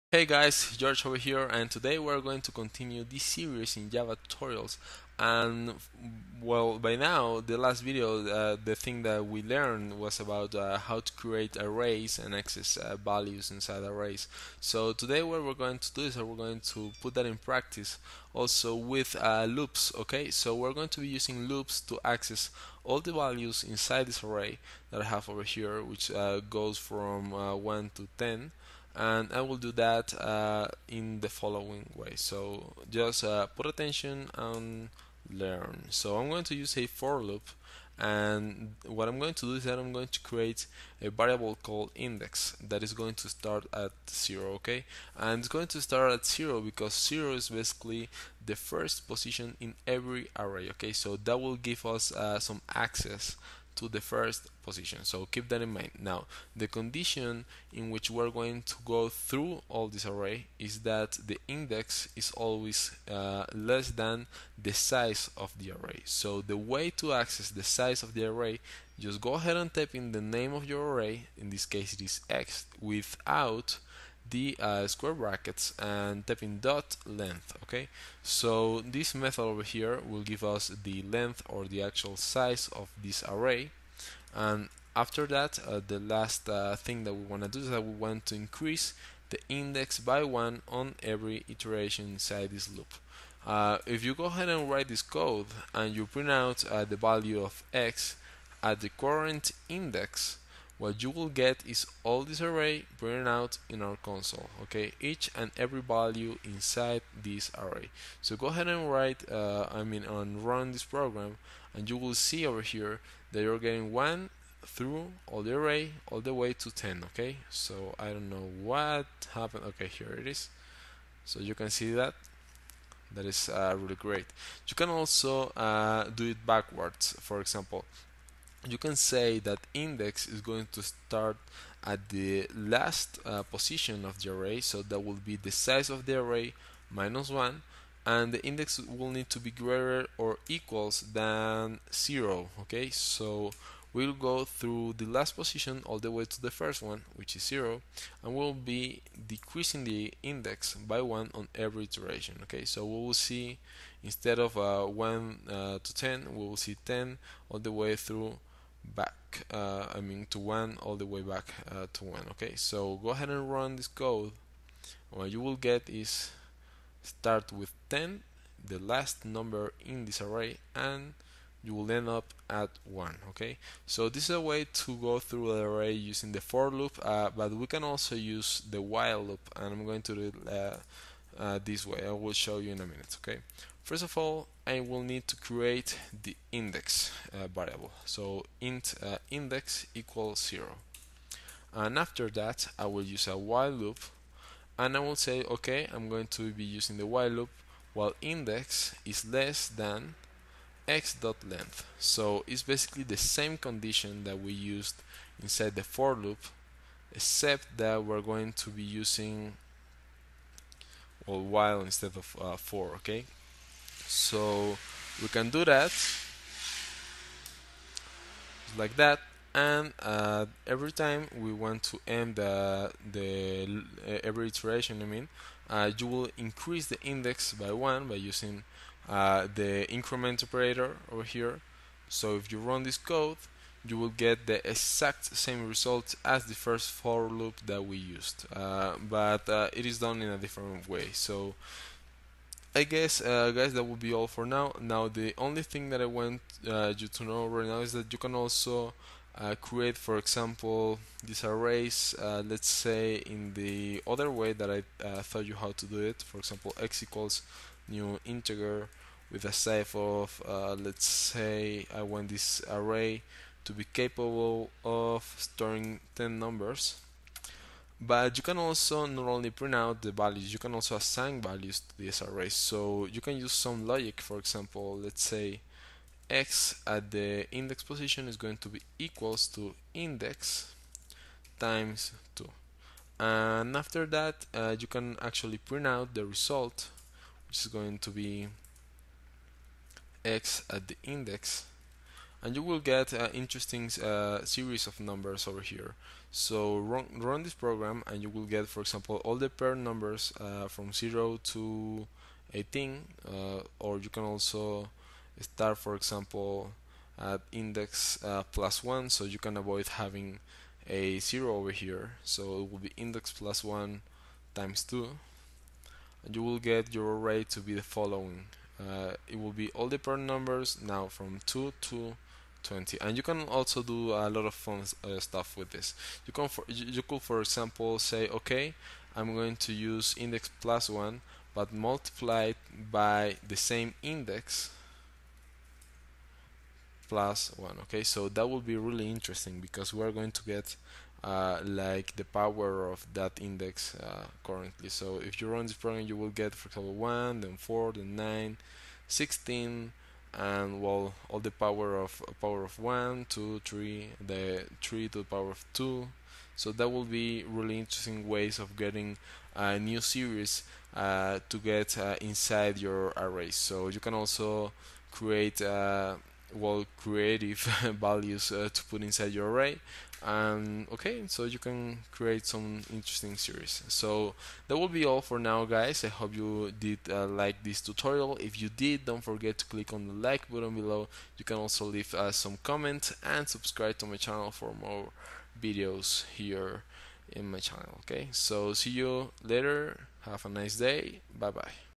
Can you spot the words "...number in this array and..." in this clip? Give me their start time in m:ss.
2:49.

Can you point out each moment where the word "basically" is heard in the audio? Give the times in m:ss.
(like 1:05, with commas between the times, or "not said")
0:47, 3:22.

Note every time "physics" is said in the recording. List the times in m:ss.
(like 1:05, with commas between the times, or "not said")
not said.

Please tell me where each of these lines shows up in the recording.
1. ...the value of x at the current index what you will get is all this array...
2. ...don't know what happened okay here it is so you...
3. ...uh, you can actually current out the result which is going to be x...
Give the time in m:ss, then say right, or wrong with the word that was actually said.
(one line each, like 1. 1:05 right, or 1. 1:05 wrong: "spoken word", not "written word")
1. 1:36 right
2. 1:58 right
3. 4:44 wrong: "print", not "current".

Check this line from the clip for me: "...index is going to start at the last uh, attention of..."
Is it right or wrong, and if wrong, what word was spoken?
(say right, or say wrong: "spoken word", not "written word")
wrong: "position", not "attention".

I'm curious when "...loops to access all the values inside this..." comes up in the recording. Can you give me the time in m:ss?
0:21.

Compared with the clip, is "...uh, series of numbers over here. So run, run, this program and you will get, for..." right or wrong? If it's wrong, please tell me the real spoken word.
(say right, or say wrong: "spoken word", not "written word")
right.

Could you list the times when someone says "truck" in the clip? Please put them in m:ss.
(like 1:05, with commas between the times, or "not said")
not said.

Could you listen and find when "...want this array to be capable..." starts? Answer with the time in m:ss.
4:22.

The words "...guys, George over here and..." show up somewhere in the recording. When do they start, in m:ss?
0:00.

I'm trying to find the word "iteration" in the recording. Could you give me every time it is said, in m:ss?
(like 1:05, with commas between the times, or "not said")
1:31, 2:31, 3:44.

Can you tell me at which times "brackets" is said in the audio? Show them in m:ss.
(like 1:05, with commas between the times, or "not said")
1:15.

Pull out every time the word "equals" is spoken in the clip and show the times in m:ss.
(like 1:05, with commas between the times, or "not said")
2:20, 3:09, 4:17, 4:38.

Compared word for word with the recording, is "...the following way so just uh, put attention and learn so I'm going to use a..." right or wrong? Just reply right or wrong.
right.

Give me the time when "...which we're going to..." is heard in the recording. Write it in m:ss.
0:57.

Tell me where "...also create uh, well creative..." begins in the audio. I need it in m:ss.
6:04.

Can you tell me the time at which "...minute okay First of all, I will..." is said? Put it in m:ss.
3:02.